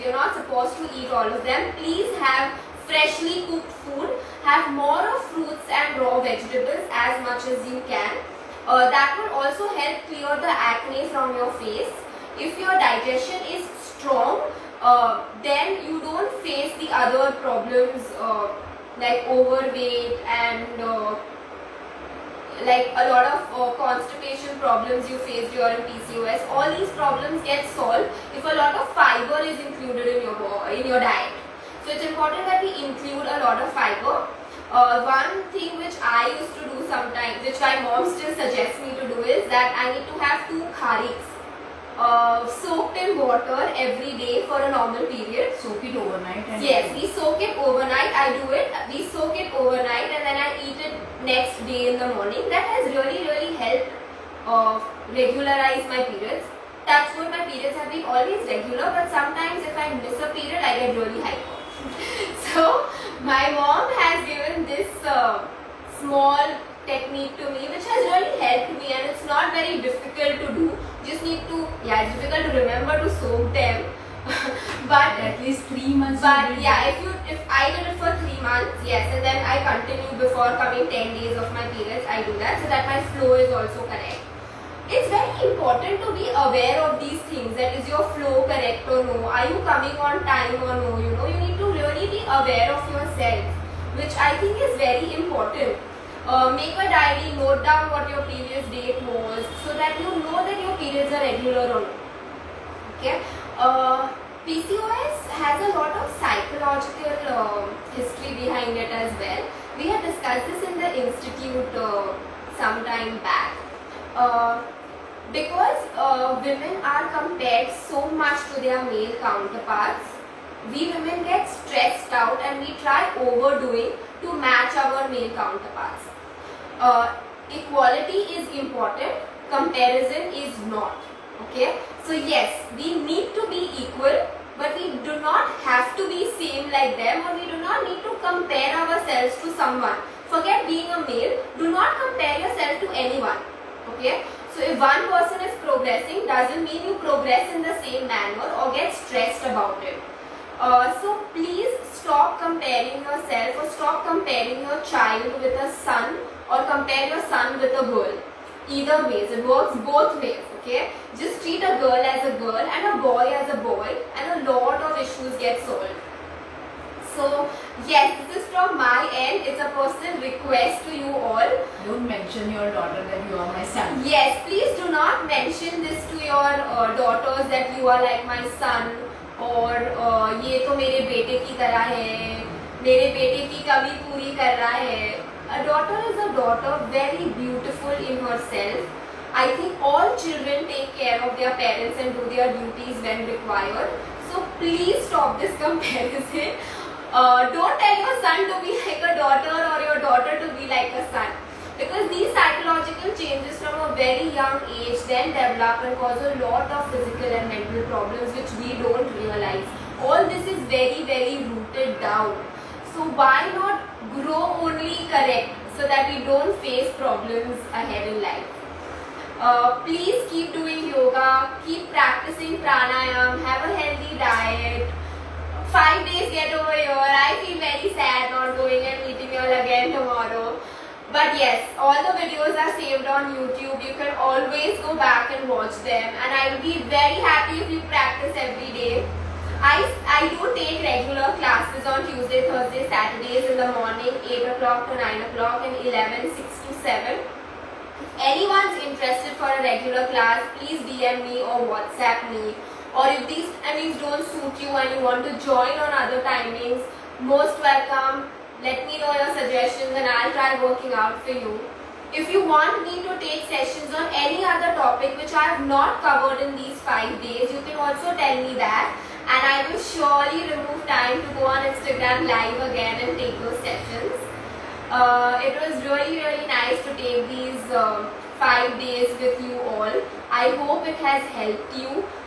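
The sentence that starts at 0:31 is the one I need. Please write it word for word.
So it's important that we include a lot of fiber.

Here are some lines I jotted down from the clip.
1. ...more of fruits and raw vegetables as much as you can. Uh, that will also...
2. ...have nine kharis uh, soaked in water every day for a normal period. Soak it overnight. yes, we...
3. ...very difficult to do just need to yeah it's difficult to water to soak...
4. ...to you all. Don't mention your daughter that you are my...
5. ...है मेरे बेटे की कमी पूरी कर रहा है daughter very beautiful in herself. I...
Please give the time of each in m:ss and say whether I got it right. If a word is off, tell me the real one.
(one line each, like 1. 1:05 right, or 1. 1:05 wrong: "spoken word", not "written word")
1. 0:04 right
2. 0:40 wrong: "two", not "nine"
3. 1:09 wrong: "remember", not "water"
4. 2:50 right
5. 3:01 right.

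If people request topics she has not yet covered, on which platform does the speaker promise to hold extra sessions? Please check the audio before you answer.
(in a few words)
Instagram live.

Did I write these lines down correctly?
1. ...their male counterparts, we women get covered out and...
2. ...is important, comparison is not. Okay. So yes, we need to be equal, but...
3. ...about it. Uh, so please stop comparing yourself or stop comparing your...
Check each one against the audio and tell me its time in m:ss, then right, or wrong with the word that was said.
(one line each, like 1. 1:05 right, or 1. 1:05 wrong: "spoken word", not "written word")
1. 1:58 wrong: "stressed", not "covered"
2. 2:08 right
3. 2:29 right.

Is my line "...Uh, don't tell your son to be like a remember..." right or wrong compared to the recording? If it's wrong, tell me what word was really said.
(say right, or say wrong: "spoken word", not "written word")
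wrong: "daughter", not "remember".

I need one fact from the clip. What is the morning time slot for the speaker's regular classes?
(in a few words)
8 to 9 o'clock.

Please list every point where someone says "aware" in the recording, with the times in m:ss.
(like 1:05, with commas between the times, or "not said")
1:26, 1:32.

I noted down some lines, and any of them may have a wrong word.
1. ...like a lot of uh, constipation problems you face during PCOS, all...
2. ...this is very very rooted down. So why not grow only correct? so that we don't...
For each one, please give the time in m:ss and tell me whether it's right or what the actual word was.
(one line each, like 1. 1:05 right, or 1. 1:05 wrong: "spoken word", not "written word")
1. 0:22 right
2. 3:30 right.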